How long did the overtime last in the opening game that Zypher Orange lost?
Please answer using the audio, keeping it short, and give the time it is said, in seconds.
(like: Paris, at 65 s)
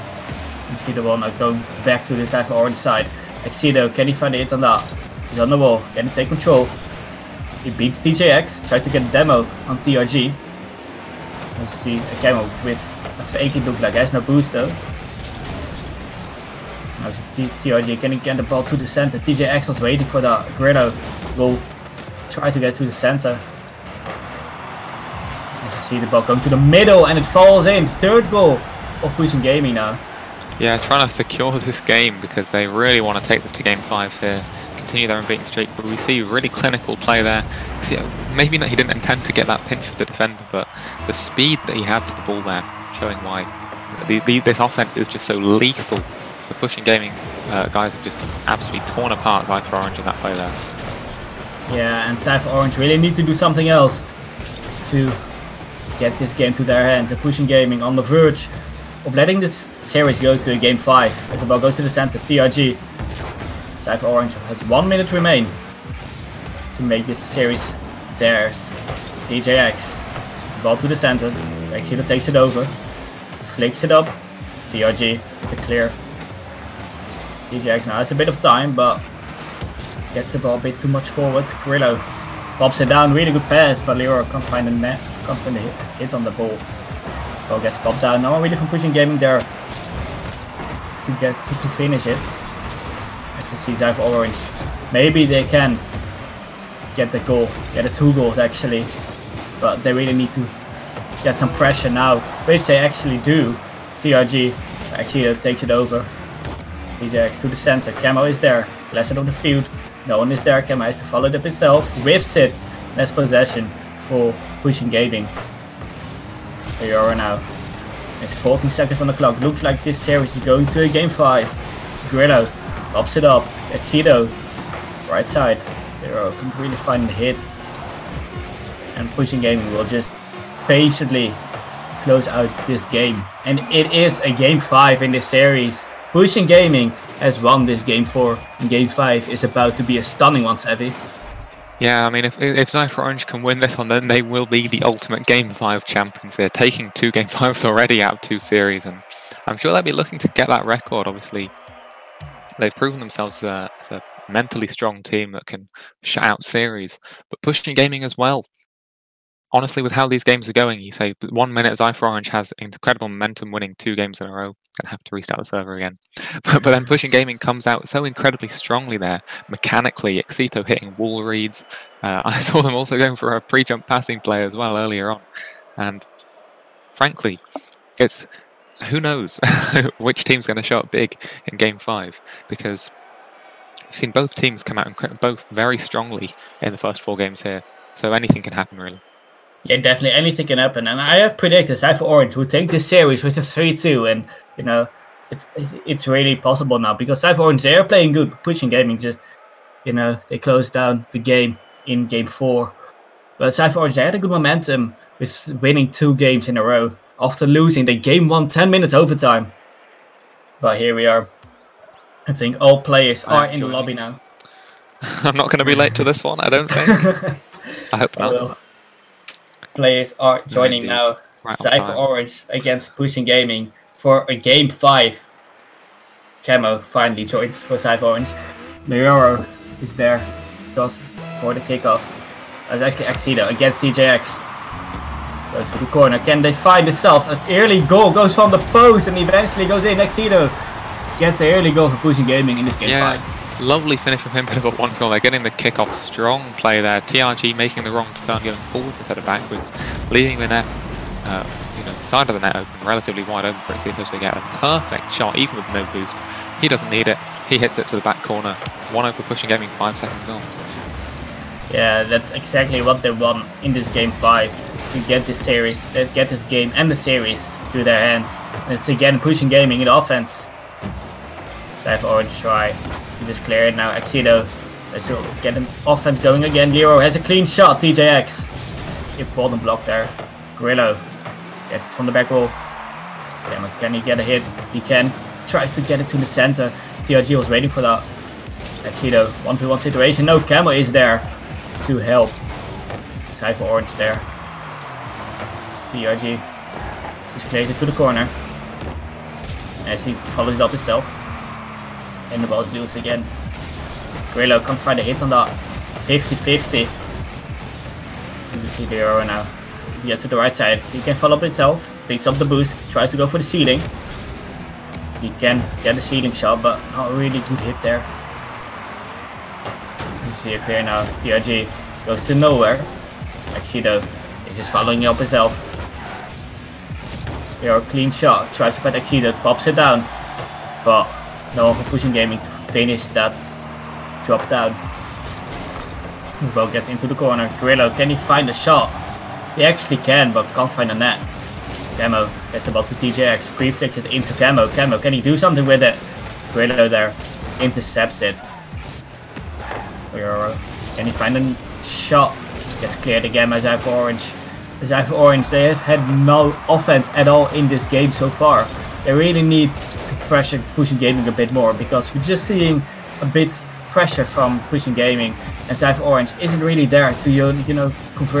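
10 minutes, at 208 s.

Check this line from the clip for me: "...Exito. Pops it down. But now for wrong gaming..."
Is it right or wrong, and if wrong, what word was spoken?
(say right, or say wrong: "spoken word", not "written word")
wrong: "pushing", not "wrong".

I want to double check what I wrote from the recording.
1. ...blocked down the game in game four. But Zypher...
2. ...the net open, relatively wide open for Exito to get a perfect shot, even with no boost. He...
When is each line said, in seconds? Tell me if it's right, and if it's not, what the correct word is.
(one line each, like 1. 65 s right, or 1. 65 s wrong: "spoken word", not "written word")
1. 200 s wrong: "closed", not "blocked"
2. 252 s right.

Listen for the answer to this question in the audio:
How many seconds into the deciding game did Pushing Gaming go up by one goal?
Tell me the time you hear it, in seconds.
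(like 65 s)
259 s.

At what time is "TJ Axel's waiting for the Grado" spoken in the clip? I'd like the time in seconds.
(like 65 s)
19 s.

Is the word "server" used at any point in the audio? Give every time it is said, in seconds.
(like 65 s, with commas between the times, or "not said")
165 s.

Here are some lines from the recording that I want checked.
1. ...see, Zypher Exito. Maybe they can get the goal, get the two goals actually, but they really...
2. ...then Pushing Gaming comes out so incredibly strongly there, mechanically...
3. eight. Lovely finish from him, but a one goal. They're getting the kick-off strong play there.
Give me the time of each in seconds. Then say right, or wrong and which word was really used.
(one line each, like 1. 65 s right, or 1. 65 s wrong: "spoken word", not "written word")
1. 93 s wrong: "Orange", not "Exito"
2. 166 s right
3. 243 s wrong: "five", not "eight".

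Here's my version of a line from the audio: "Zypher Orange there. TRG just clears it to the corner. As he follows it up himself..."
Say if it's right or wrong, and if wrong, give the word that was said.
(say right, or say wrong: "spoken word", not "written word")
right.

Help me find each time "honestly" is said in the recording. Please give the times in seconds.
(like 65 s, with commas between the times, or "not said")
159 s.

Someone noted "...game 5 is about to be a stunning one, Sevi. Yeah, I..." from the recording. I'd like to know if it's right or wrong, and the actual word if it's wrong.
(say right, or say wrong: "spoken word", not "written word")
right.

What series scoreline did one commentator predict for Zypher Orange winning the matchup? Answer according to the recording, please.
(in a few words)
3-2.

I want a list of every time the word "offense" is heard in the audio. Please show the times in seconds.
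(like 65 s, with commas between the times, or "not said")
44 s, 269 s, 275 s, 356 s.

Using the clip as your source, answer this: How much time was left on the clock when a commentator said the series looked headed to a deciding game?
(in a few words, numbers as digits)
14 seconds.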